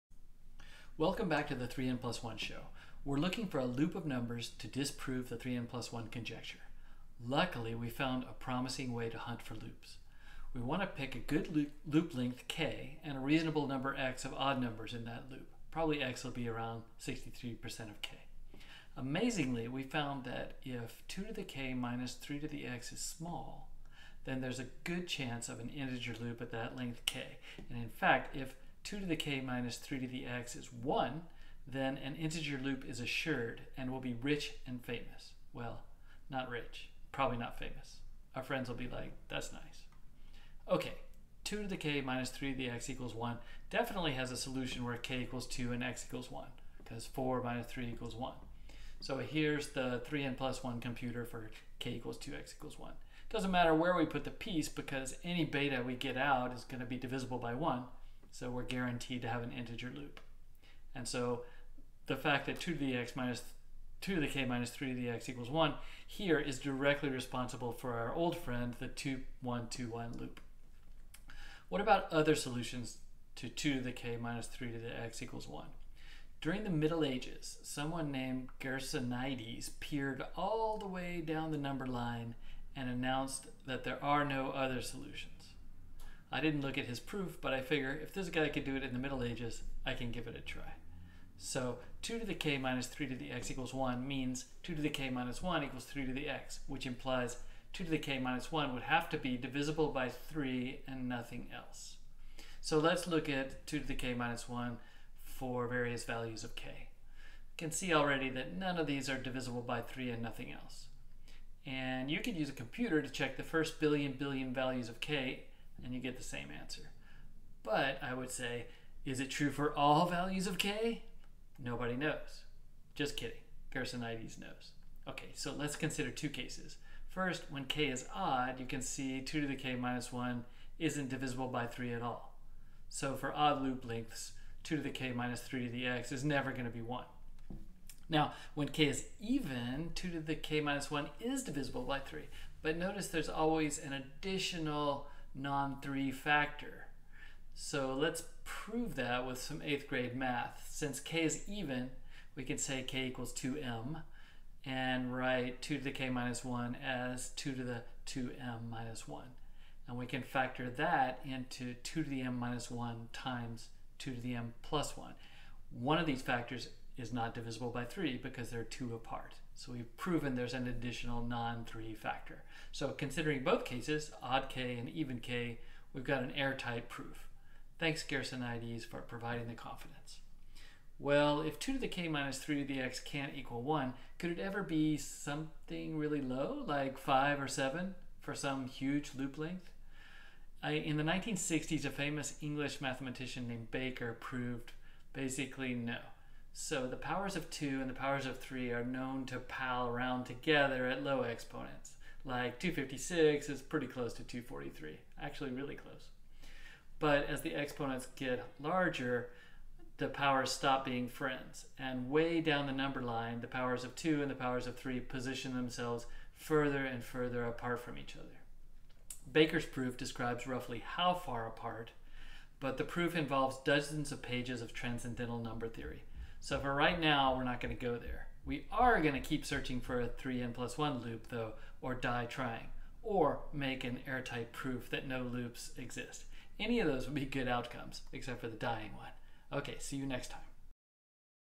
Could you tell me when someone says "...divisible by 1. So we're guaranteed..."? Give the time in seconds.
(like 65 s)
56 s.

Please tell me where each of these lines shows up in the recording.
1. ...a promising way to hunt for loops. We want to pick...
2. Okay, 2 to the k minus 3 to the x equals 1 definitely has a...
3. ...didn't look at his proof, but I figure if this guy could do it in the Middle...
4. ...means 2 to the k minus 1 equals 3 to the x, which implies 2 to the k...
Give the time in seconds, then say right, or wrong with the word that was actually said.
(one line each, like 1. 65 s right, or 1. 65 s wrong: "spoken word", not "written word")
1. 8 s right
2. 40 s right
3. 86 s right
4. 94 s right.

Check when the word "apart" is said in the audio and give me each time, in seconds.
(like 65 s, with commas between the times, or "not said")
168 s, 217 s, 221 s.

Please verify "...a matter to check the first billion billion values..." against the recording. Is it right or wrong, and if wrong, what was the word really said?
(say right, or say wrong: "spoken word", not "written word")
wrong: "computer", not "matter".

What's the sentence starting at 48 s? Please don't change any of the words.
So here's the 3n plus 1 computer for k equals 2x equals 1.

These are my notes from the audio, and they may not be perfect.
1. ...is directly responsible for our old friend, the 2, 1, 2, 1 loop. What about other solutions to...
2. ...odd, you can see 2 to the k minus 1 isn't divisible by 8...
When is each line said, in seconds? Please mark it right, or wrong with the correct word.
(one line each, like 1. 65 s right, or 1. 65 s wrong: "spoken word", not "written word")
1. 66 s right
2. 128 s wrong: "3", not "8".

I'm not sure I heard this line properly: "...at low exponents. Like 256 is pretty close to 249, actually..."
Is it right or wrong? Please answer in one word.
wrong.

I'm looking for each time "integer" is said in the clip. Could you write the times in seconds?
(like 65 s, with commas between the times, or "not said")
25 s, 32 s, 59 s.